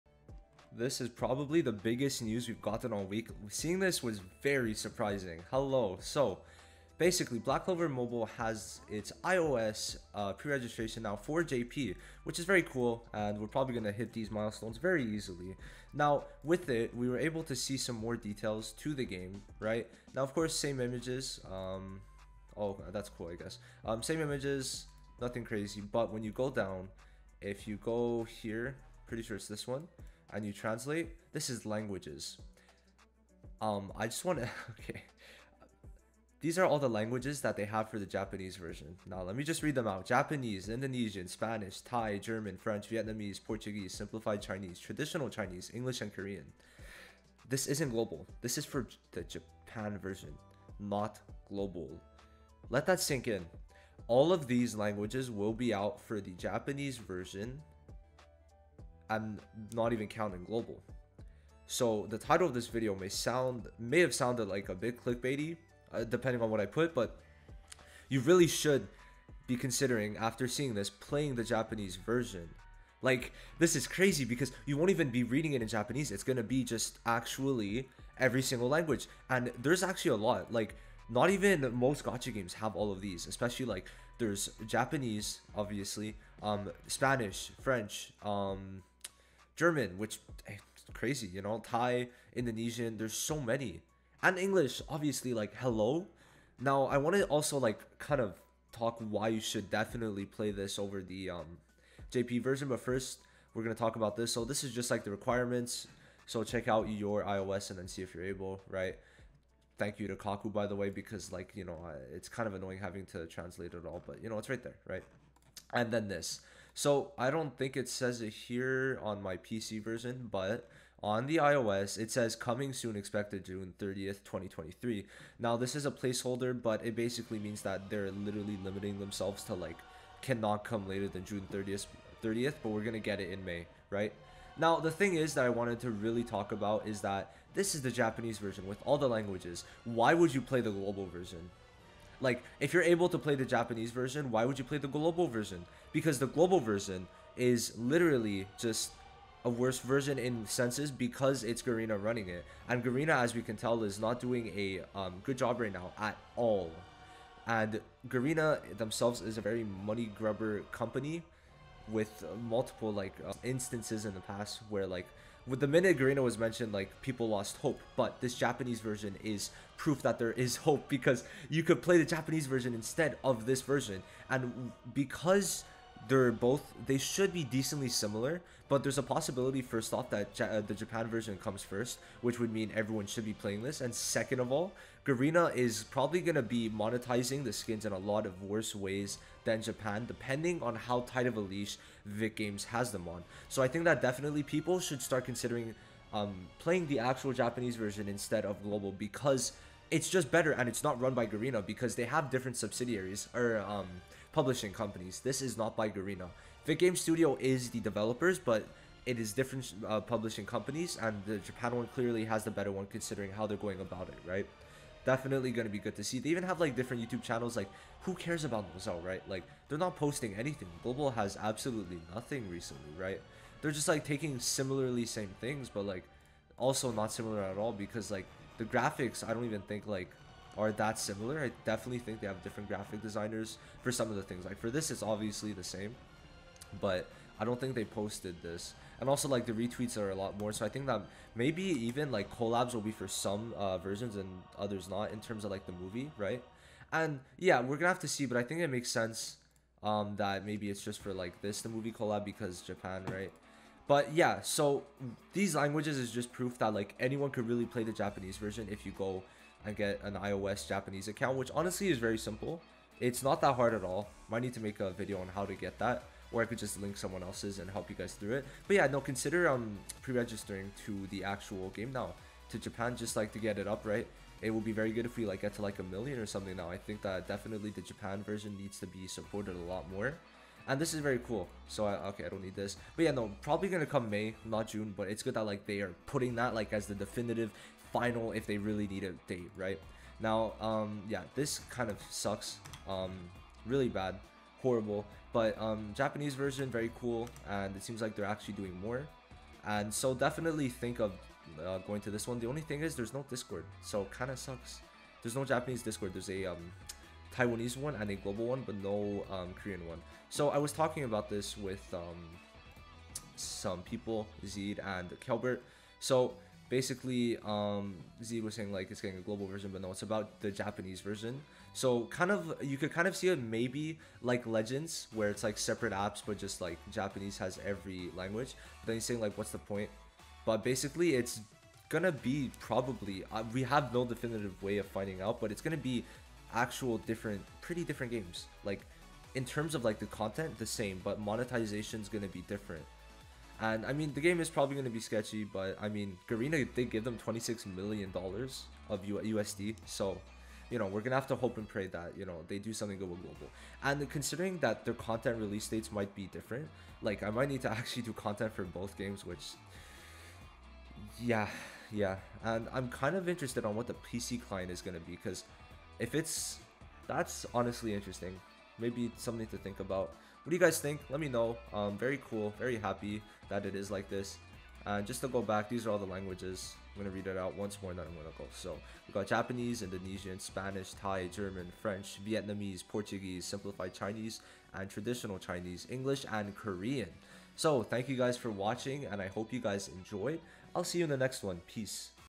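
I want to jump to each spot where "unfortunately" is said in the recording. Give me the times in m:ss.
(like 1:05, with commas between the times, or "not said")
not said.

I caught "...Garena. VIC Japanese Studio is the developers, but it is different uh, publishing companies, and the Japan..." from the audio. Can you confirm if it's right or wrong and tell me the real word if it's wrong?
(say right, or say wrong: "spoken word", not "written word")
wrong: "Game", not "Japanese".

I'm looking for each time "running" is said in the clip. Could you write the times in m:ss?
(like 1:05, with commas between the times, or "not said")
2:32.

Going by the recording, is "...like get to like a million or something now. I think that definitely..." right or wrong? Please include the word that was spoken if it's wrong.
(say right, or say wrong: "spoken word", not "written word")
right.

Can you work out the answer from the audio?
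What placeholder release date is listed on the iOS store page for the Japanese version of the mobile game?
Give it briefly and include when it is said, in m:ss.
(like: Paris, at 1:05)
June 30th, 2023, at 2:03.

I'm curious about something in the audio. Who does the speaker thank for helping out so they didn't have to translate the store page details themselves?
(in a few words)
Kaku.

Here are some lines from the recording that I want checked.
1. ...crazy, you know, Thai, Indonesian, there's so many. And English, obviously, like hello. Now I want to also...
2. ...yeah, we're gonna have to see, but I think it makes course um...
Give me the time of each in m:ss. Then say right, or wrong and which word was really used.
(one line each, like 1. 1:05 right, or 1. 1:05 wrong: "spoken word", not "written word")
1. 1:30 right
2. 4:07 wrong: "sense", not "course".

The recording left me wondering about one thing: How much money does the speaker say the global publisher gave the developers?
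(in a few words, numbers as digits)
26 million dollars.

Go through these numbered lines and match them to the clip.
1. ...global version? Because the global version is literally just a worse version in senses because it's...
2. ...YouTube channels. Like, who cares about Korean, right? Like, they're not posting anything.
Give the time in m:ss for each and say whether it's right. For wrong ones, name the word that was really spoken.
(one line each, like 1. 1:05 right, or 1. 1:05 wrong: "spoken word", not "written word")
1. 2:24 right
2. 3:37 wrong: "Mozell", not "Korean".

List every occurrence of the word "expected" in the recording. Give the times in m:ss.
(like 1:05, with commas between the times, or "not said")
2:02.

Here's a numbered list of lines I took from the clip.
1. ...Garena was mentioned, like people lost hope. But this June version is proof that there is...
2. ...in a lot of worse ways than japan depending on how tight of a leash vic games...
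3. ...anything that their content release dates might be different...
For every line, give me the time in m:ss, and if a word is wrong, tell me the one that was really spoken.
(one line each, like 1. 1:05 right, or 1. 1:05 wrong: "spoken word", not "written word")
1. 2:45 wrong: "Japanese", not "June"
2. 3:07 right
3. 5:54 wrong: "considering", not "anything".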